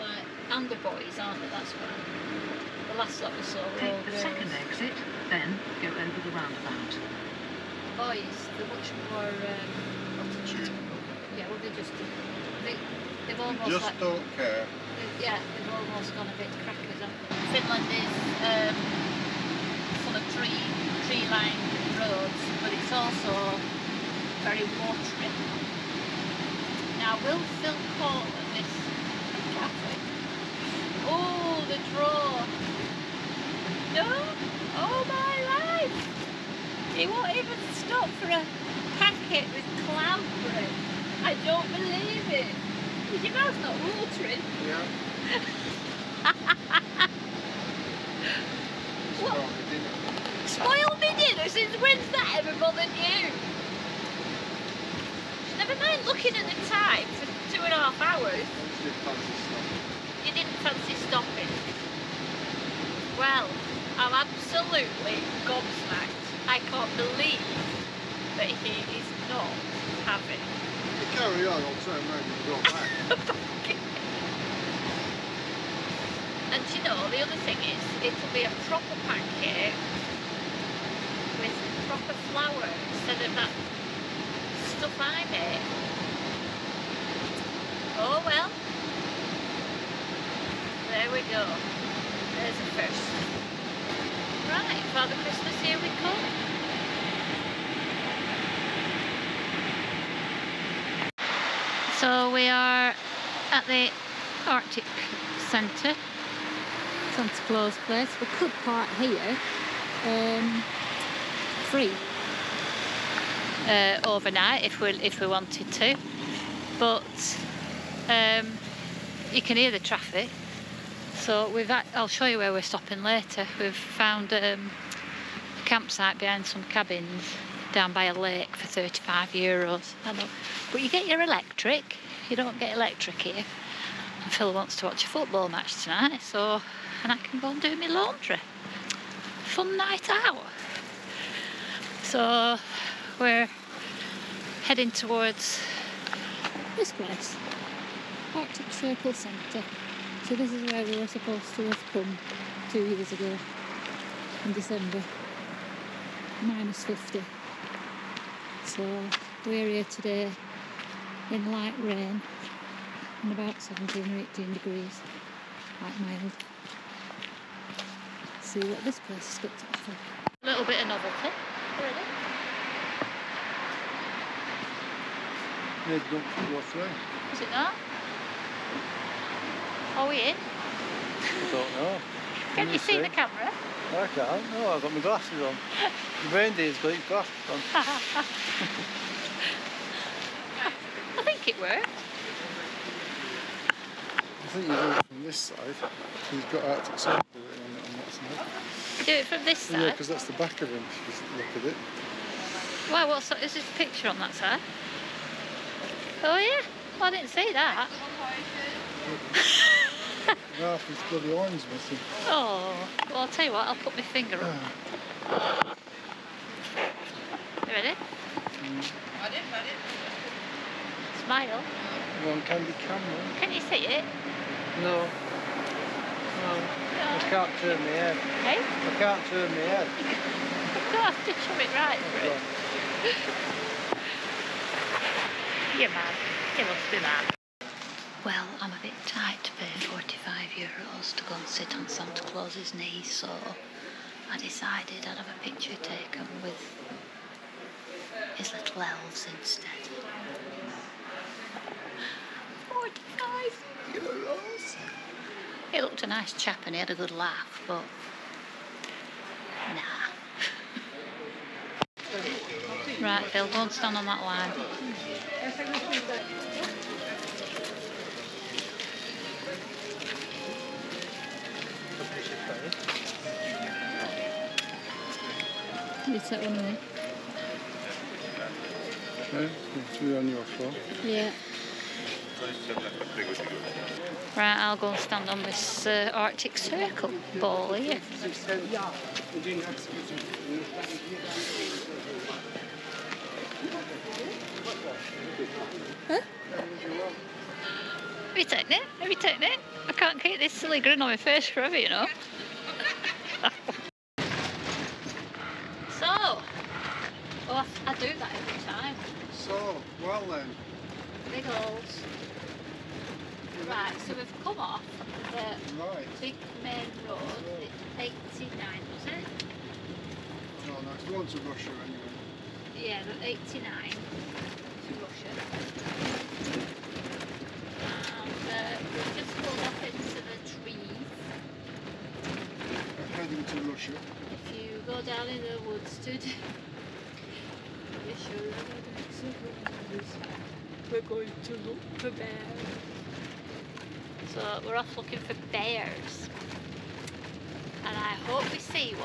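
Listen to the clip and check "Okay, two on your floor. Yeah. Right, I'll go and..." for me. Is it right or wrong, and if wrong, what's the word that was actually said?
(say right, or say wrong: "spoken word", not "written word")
right.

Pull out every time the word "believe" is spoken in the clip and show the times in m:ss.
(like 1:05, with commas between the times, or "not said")
0:41, 1:06.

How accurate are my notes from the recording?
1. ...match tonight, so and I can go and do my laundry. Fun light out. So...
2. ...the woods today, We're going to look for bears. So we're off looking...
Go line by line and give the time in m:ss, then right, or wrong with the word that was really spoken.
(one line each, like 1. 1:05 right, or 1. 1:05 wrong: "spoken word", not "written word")
1. 2:15 wrong: "night", not "light"
2. 5:35 right.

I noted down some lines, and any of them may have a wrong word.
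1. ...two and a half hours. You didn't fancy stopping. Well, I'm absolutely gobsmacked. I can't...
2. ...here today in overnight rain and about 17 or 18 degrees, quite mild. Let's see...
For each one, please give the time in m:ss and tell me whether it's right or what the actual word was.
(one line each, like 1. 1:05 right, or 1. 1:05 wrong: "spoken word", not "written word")
1. 0:57 right
2. 2:39 wrong: "light", not "overnight".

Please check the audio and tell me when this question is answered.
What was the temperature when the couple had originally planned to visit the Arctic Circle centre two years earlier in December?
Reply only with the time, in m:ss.
2:36.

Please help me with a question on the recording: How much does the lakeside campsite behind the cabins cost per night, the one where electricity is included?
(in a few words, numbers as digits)
35 euros.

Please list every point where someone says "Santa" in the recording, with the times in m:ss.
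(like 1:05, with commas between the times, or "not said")
1:47, 4:01.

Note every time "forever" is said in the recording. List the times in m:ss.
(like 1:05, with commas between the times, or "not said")
5:01.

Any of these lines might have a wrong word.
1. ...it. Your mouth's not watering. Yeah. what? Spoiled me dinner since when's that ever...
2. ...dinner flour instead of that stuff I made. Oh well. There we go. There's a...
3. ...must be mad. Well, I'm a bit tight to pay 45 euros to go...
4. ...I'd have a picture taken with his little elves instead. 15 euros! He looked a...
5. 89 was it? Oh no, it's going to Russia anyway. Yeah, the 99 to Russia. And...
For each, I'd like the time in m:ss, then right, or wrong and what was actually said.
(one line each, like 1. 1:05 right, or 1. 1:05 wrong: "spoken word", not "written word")
1. 0:42 right
2. 1:21 wrong: "proper", not "dinner"
3. 3:56 right
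4. 4:05 wrong: "45", not "15"
5. 5:18 wrong: "89", not "99".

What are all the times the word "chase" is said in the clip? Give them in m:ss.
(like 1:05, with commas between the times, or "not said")
not said.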